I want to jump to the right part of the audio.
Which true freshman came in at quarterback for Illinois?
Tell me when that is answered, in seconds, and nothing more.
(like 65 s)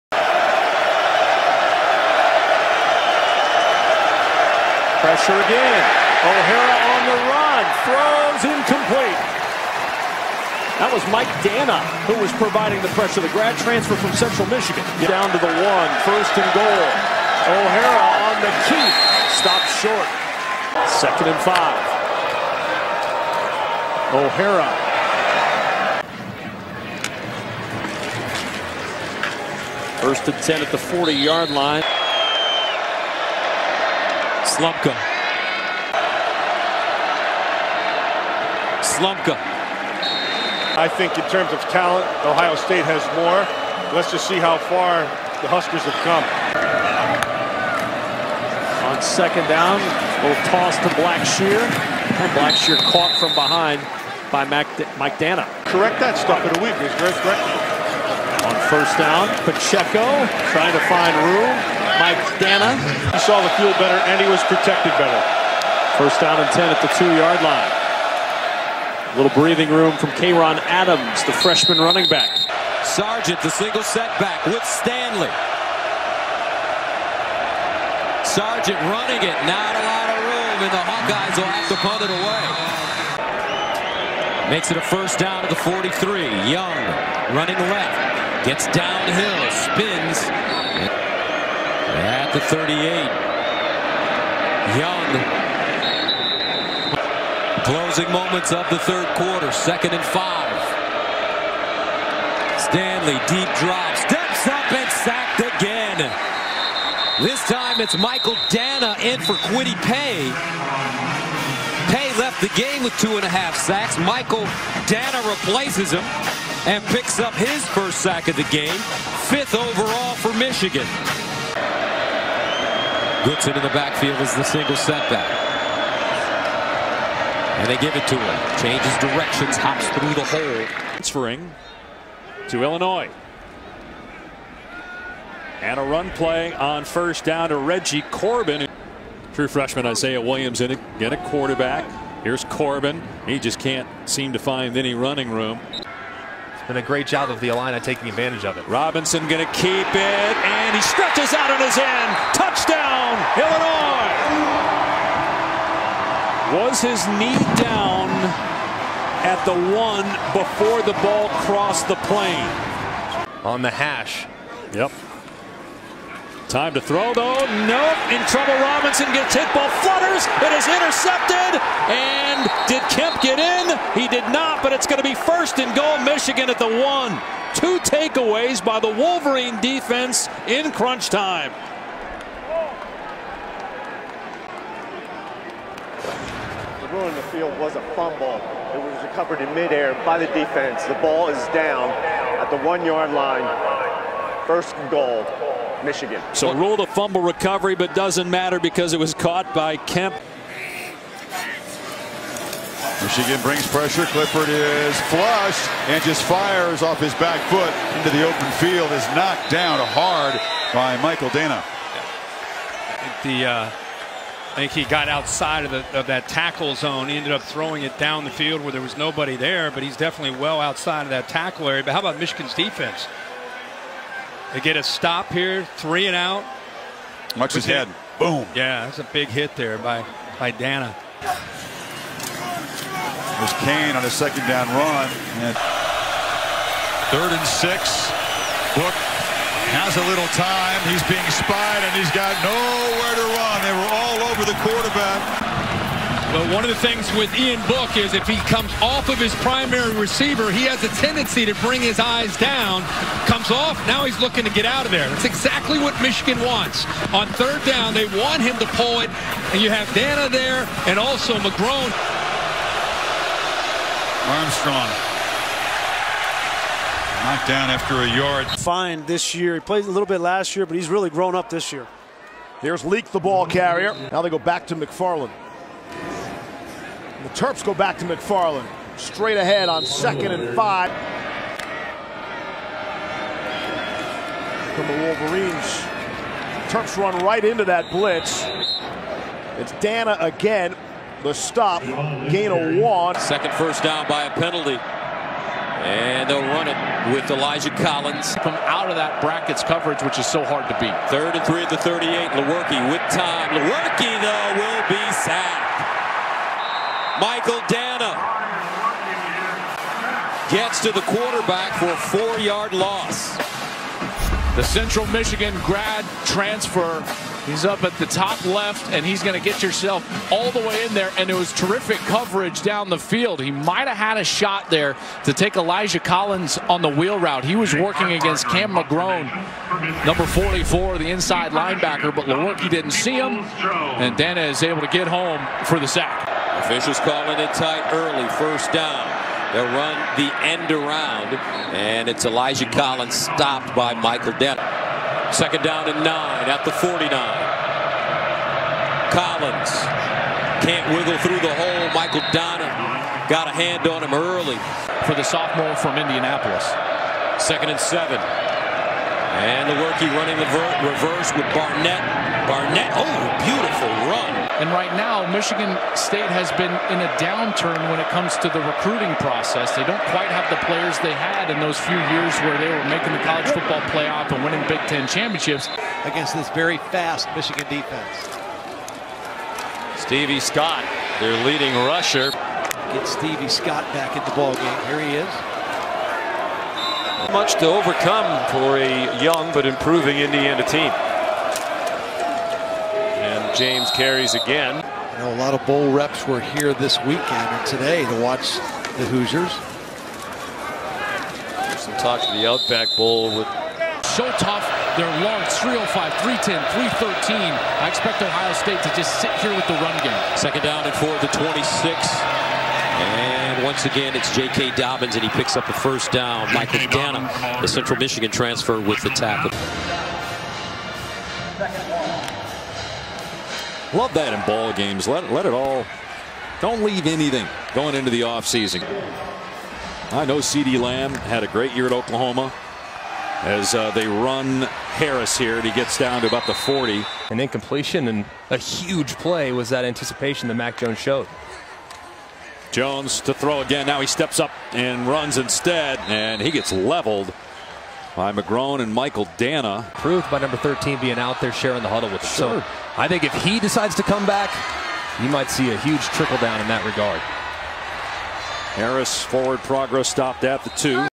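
139 s.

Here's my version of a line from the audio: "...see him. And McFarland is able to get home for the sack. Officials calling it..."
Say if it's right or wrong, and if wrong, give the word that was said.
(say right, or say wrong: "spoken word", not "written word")
wrong: "Danna", not "McFarland".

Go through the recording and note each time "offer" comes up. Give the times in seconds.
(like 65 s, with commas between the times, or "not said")
not said.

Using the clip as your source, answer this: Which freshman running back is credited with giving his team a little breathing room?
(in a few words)
Kayron Adams.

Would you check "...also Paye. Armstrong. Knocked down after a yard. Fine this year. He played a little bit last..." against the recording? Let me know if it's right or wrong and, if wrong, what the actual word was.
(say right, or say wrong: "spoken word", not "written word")
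wrong: "McGrone", not "Paye".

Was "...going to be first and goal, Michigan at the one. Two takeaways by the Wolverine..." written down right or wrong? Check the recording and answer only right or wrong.
right.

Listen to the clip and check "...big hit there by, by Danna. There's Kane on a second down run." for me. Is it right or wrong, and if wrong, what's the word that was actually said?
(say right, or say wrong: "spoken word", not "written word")
right.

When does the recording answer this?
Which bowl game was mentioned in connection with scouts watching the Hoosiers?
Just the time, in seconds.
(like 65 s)
402 s.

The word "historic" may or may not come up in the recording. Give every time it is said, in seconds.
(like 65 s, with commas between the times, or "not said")
not said.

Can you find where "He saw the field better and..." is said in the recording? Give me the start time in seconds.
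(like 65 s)
63 s.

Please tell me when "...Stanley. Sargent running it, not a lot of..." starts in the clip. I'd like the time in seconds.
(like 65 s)
74 s.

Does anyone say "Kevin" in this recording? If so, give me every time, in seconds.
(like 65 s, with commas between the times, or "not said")
not said.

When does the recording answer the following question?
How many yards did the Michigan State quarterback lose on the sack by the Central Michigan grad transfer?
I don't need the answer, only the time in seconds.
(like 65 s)
311 s.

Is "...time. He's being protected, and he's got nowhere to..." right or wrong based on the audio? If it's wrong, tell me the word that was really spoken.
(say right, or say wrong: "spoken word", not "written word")
wrong: "spied", not "protected".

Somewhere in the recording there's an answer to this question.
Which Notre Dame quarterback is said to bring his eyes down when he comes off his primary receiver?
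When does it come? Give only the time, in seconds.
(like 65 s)
247 s.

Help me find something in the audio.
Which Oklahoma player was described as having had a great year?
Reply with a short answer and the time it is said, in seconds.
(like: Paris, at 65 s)
CeeDee Lamb, at 430 s.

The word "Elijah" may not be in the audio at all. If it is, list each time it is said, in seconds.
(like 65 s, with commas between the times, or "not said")
297 s, 325 s, 342 s.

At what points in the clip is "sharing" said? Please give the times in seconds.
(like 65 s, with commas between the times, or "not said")
451 s.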